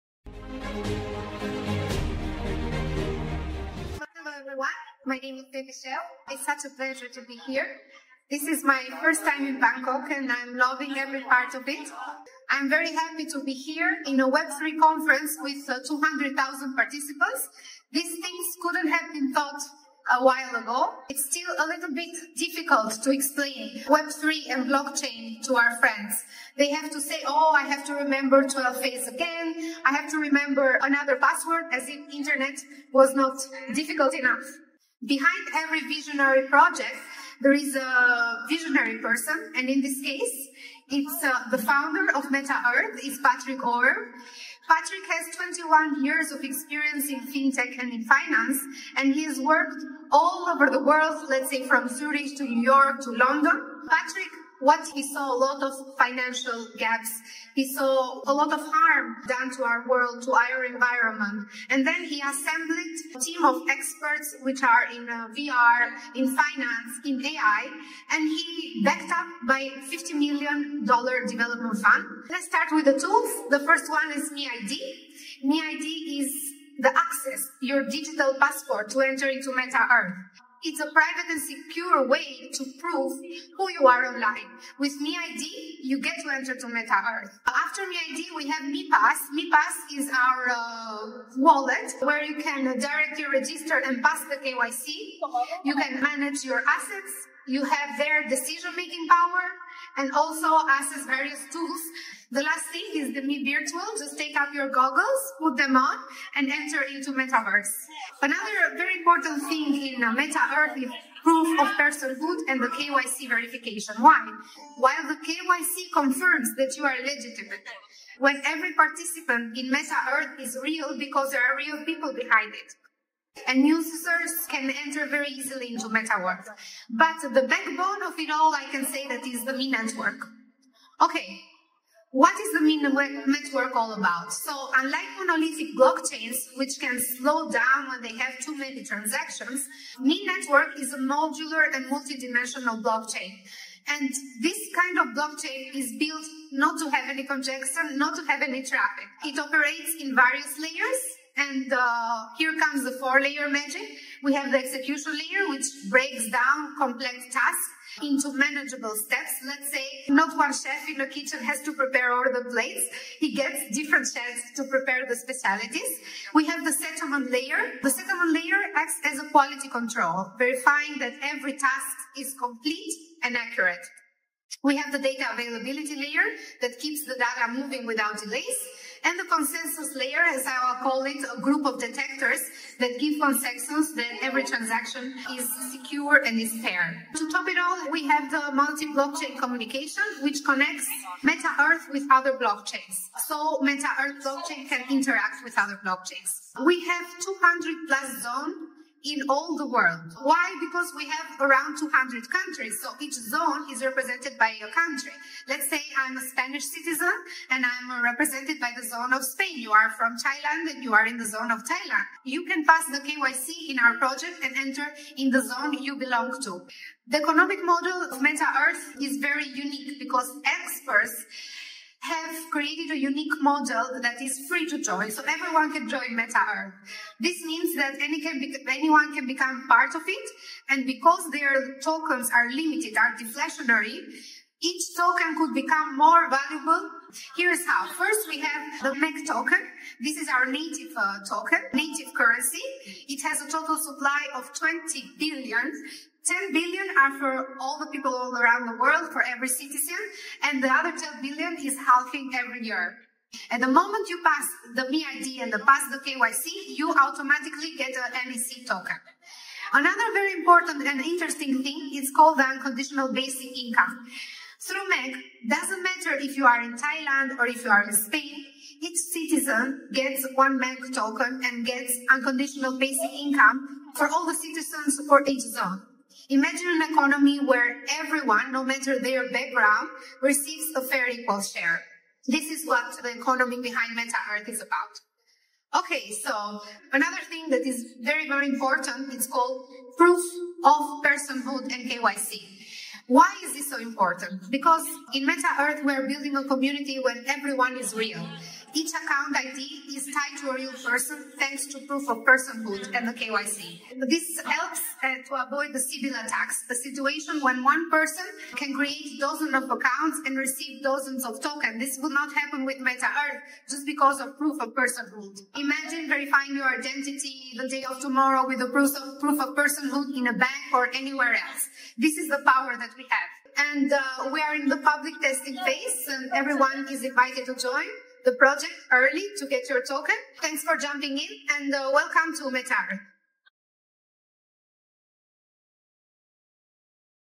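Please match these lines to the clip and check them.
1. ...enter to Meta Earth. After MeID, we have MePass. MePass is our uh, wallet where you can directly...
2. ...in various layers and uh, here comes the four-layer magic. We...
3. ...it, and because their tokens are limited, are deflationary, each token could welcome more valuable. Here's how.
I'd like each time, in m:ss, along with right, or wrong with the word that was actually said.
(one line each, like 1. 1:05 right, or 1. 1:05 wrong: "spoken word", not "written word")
1. 1:26 right
2. 2:29 right
3. 3:50 wrong: "become", not "welcome".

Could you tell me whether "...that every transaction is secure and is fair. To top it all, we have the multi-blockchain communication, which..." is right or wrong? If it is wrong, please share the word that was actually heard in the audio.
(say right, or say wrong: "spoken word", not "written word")
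right.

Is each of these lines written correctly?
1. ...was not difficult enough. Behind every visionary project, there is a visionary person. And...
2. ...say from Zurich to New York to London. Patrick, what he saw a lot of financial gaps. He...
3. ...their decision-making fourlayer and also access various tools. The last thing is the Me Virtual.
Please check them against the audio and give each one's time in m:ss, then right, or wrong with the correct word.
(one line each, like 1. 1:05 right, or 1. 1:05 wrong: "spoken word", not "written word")
1. 0:32 right
2. 0:51 right
3. 1:37 wrong: "power", not "fourlayer".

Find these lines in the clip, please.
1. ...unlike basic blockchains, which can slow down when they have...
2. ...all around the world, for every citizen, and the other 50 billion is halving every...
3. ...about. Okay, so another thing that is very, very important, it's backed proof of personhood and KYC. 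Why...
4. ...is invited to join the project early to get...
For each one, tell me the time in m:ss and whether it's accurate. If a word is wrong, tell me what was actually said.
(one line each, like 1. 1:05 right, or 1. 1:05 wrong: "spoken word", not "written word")
1. 2:14 wrong: "monolithic", not "basic"
2. 4:08 wrong: "10", not "50"
3. 4:44 wrong: "called", not "backed"
4. 5:26 right.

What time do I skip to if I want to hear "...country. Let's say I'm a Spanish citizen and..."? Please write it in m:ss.
3:24.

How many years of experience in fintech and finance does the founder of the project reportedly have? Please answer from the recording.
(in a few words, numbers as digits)
21.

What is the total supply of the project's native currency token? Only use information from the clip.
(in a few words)
20 billion.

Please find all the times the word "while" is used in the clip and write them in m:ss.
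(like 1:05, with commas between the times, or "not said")
0:20, 1:54.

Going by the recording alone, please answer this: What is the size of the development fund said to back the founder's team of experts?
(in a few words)
$50 million.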